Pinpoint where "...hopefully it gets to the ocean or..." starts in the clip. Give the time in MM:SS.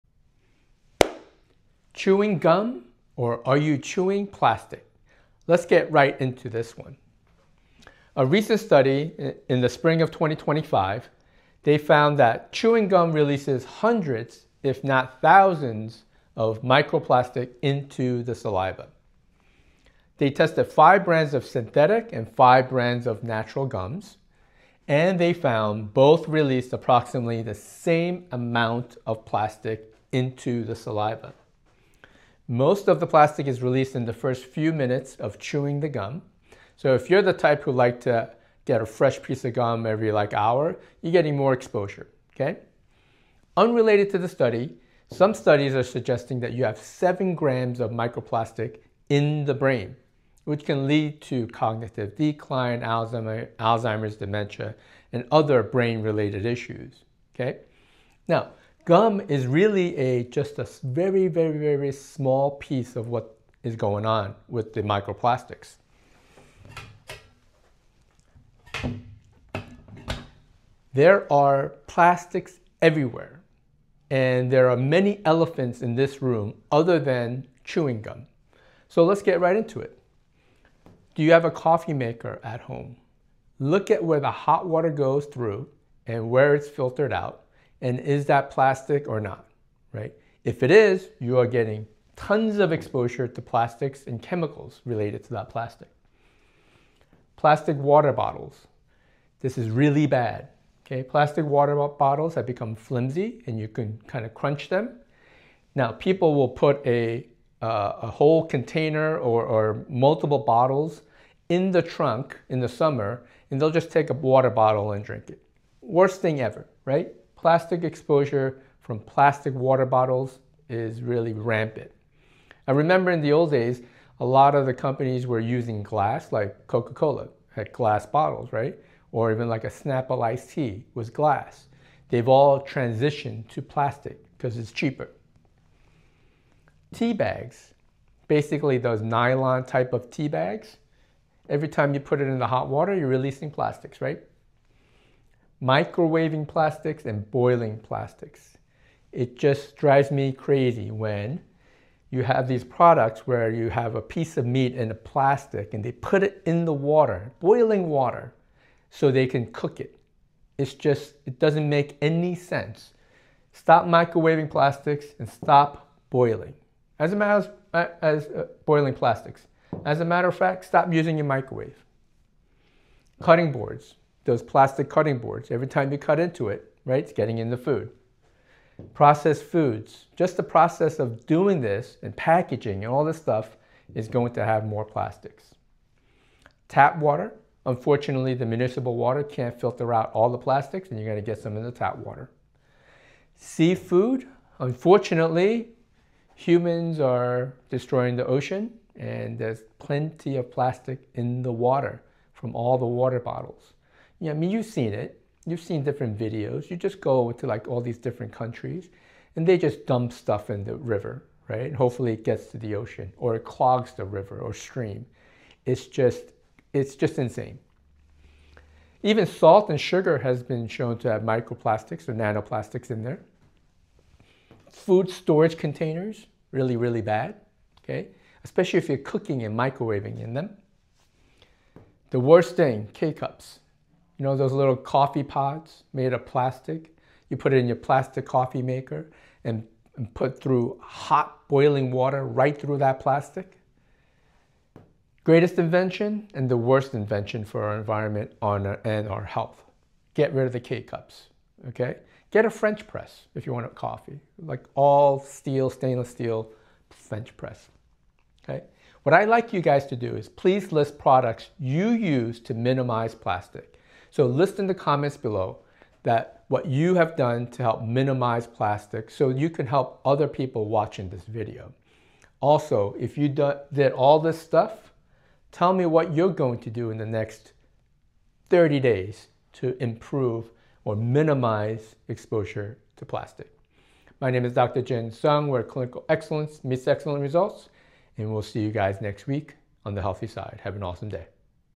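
03:31.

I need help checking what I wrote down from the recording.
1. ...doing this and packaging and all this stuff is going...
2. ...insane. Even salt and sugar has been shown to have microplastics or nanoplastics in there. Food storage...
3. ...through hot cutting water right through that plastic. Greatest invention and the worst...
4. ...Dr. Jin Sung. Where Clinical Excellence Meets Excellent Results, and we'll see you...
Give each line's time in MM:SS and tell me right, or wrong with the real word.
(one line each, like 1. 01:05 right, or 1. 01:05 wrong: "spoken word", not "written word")
1. 03:01 right
2. 03:37 right
3. 04:00 wrong: "boiling", not "cutting"
4. 04:44 right.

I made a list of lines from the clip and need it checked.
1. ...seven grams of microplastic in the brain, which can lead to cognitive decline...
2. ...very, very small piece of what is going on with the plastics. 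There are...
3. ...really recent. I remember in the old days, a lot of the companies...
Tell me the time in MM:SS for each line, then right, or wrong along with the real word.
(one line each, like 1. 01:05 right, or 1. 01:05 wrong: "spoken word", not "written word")
1. 00:46 right
2. 01:01 wrong: "microplastics", not "plastics"
3. 02:01 wrong: "rampant", not "recent".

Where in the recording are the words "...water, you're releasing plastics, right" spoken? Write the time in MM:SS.
02:22.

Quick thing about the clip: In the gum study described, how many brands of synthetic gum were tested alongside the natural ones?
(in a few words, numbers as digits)
5.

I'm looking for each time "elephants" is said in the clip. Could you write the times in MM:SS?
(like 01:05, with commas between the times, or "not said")
01:15.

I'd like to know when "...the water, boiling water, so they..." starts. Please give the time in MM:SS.
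02:36.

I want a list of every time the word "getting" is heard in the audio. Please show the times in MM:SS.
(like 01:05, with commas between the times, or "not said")
00:41, 01:31, 02:57.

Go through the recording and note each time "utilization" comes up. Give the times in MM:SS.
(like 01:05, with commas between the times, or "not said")
not said.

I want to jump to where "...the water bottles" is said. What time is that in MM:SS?
03:22.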